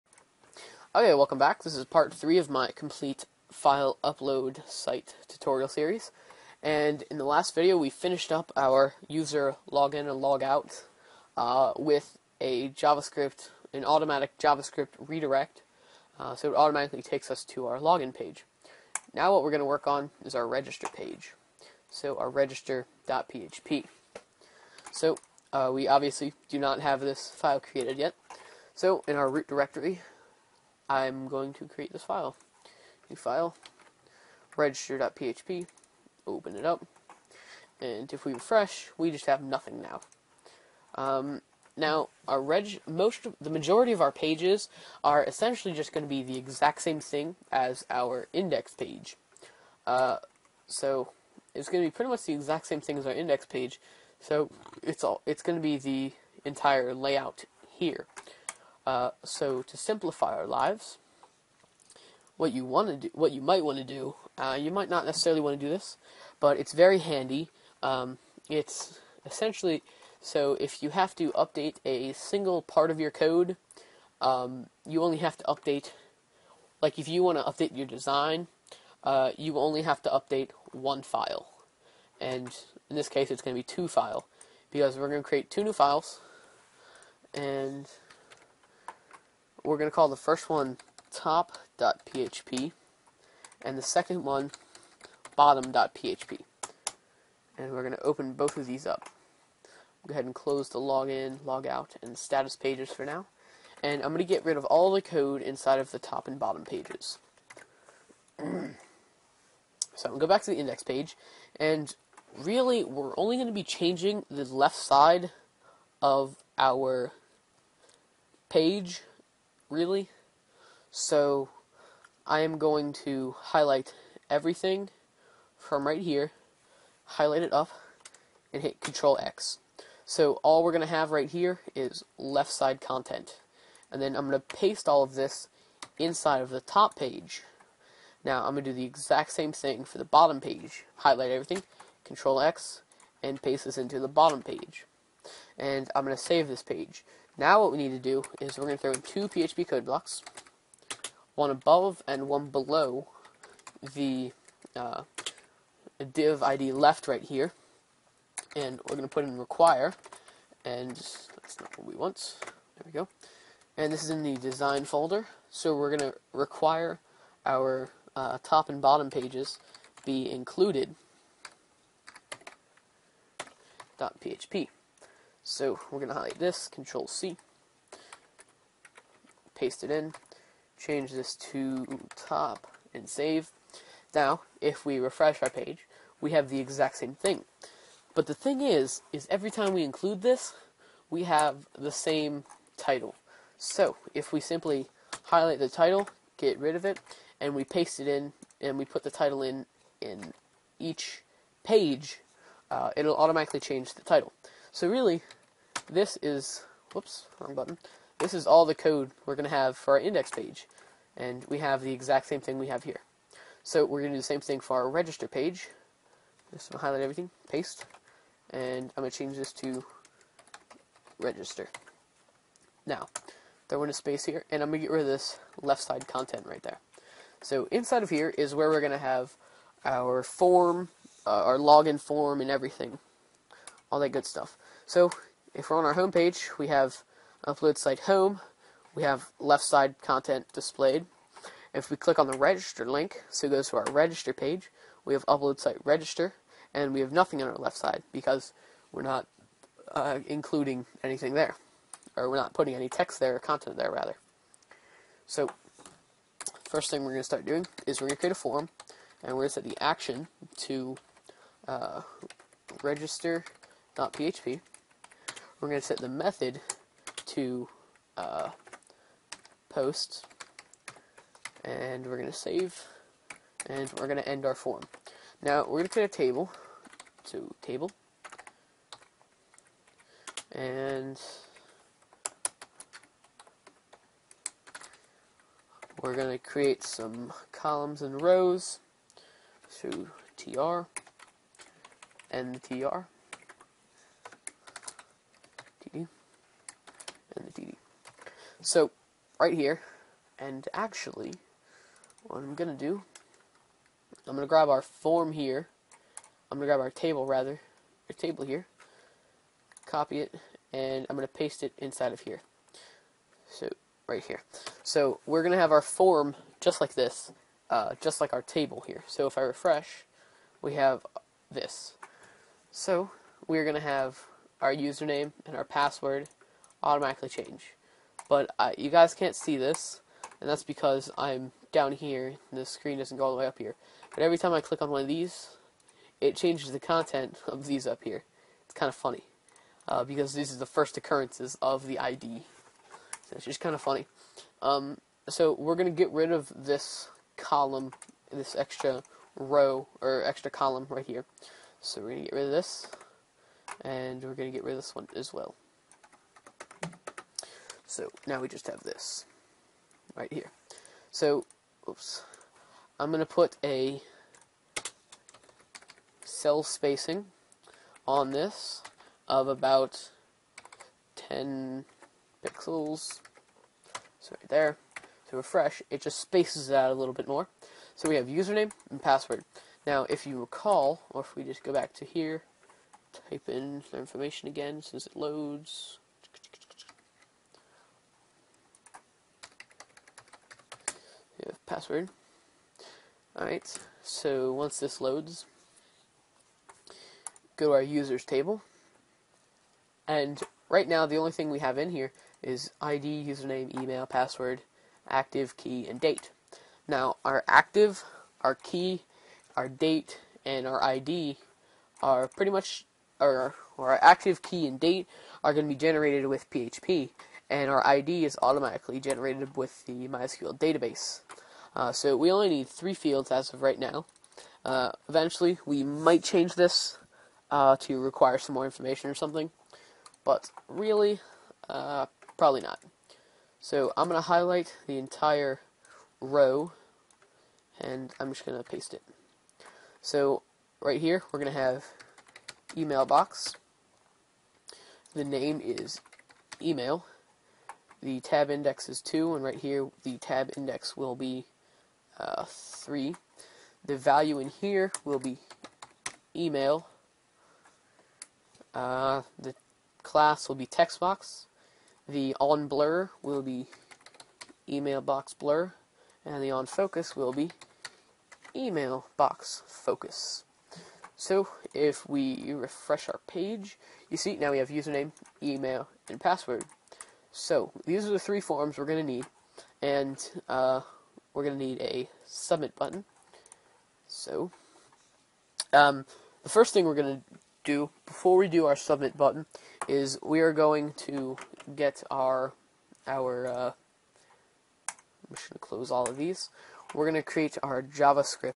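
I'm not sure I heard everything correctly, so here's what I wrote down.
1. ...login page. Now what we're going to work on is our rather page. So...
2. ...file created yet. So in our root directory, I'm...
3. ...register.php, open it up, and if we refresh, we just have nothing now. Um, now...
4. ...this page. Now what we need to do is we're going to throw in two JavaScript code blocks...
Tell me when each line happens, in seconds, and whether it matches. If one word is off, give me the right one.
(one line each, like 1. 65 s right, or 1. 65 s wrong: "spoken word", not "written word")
1. 17 s wrong: "register", not "rather"
2. 27 s right
3. 34 s right
4. 146 s wrong: "PHP", not "JavaScript".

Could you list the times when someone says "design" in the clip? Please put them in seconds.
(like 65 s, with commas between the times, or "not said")
77 s, 164 s.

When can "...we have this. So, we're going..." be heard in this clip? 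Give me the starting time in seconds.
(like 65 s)
320 s.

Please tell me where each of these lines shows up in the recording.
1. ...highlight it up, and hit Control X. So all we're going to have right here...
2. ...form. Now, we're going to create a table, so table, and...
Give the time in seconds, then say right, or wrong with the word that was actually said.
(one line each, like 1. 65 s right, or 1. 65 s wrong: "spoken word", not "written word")
1. 127 s right
2. 274 s right.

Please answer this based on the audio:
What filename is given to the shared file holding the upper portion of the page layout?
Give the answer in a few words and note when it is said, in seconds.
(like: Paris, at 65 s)
top.php, at 91 s.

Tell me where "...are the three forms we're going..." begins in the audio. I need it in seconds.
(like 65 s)
478 s.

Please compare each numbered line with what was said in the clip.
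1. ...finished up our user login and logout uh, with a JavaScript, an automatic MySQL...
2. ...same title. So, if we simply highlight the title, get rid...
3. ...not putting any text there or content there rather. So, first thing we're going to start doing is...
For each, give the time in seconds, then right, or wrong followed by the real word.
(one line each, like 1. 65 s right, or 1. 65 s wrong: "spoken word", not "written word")
1. 7 s wrong: "JavaScript", not "MySQL"
2. 191 s right
3. 252 s right.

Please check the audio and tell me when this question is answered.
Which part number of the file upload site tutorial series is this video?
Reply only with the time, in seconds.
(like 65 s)
1 s.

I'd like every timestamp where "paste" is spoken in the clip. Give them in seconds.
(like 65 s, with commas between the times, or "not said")
134 s, 143 s, 179 s, 197 s, 217 s, 311 s, 438 s.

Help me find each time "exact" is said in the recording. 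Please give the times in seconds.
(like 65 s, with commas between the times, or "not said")
46 s, 52 s, 138 s, 186 s, 211 s.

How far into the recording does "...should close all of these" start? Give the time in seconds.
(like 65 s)
495 s.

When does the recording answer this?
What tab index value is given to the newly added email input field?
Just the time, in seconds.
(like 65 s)
448 s.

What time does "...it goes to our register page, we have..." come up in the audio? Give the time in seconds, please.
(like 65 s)
243 s.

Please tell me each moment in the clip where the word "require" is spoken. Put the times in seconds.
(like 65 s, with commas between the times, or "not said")
159 s, 166 s, 427 s.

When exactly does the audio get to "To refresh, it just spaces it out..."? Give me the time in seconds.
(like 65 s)
375 s.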